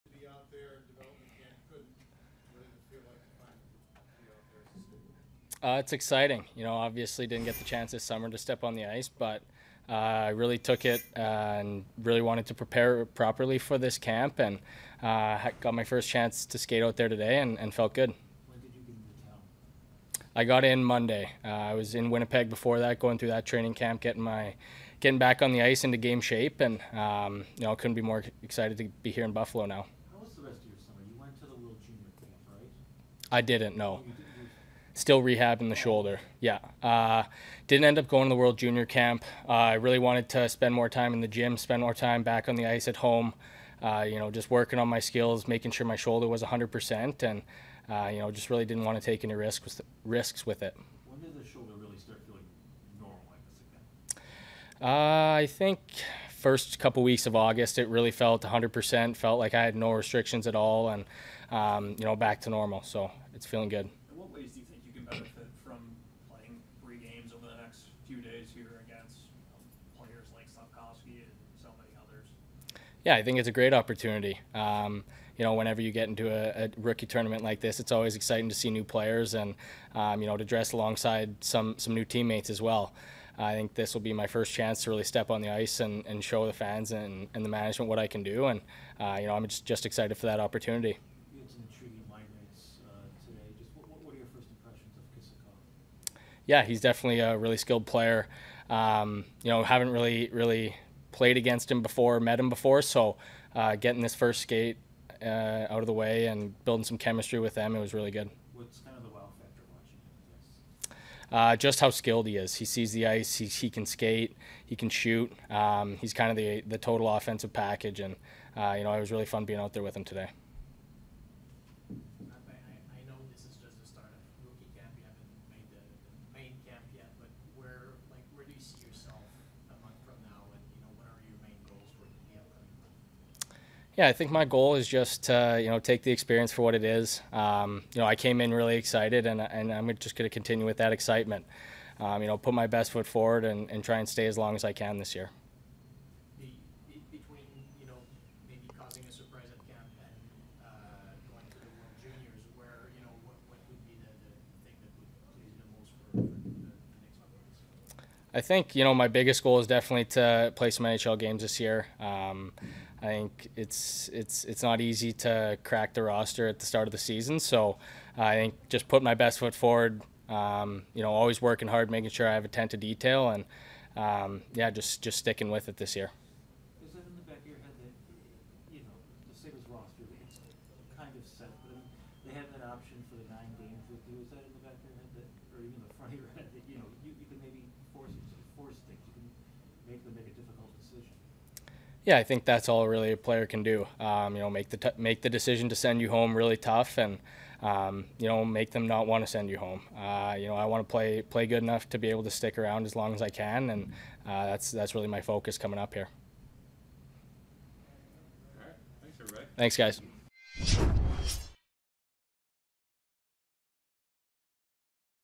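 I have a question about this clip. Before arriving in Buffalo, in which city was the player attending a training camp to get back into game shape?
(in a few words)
Winnipeg.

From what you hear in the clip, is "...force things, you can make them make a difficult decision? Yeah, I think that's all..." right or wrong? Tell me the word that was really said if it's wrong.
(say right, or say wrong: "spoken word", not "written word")
right.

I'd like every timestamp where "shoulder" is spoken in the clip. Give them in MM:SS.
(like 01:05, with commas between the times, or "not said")
00:35, 00:45, 00:51.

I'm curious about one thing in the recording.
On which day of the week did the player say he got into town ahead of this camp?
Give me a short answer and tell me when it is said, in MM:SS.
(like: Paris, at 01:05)
Monday, at 00:20.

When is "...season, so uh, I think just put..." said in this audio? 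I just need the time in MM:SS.
02:46.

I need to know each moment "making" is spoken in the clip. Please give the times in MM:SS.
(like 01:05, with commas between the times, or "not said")
00:45, 02:51.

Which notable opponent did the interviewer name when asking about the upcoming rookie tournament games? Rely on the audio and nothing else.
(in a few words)
Slafkovsky.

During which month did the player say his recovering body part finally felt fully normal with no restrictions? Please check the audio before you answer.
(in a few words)
August.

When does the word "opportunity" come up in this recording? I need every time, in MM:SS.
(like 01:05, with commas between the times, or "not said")
01:13, 01:30.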